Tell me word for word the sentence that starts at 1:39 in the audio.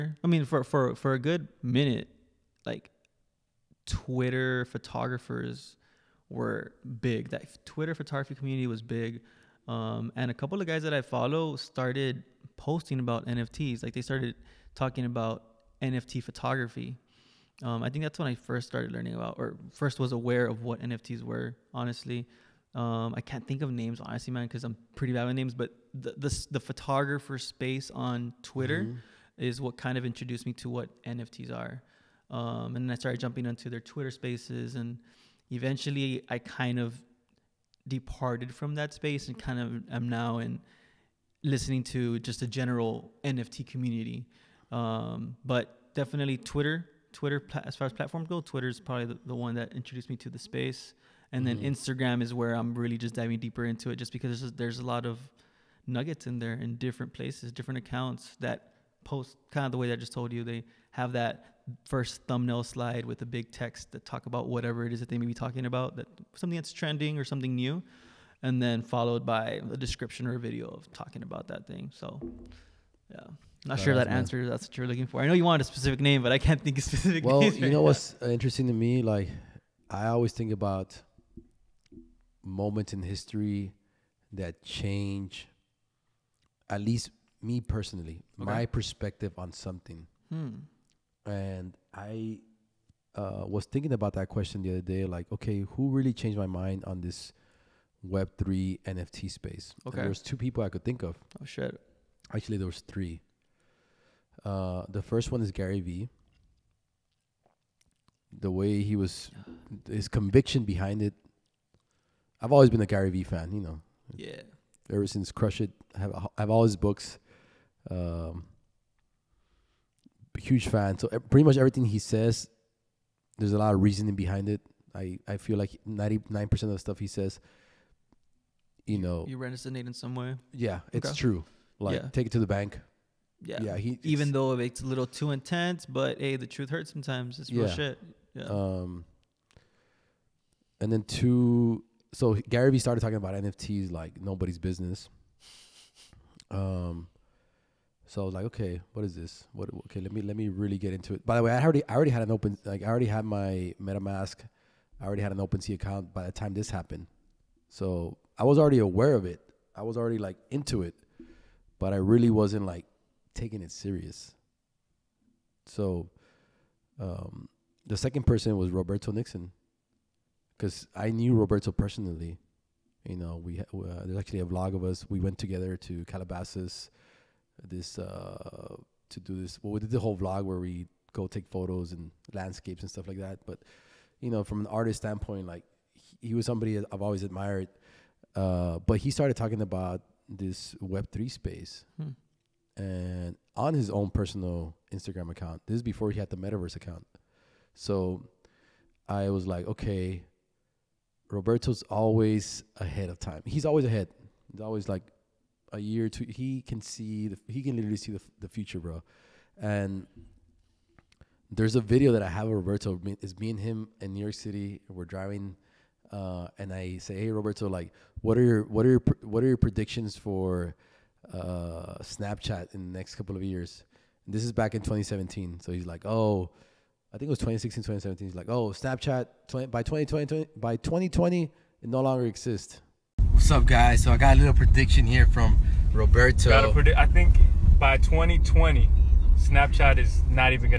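Okay, there's two people I could think of.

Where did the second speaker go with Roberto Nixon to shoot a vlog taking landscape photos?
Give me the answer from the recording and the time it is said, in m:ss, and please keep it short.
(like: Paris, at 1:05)
Calabasas, at 2:56.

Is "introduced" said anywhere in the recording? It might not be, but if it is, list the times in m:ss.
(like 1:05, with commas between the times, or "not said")
0:30, 0:49.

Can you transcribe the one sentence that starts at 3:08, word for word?
Uh, but he started talking about this Web three space, hmm.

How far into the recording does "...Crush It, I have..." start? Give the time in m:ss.
1:55.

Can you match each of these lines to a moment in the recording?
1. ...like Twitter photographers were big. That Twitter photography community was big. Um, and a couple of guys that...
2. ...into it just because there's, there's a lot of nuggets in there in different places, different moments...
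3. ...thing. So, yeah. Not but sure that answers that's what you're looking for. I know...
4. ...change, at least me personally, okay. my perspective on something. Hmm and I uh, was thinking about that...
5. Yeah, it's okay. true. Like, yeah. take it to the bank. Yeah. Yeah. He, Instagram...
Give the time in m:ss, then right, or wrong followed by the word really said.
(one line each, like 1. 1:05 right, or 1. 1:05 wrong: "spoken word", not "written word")
1. 0:02 right
2. 0:53 wrong: "accounts", not "moments"
3. 1:11 right
4. 1:24 right
5. 2:10 wrong: "Even", not "Instagram".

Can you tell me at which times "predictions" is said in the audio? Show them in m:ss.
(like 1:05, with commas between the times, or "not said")
3:39, 3:54.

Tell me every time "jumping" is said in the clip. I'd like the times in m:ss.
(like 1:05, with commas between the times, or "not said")
0:33.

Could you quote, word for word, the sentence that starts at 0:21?
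Honestly, um, I can't think of names honestly, man, because I'm pretty bad with names.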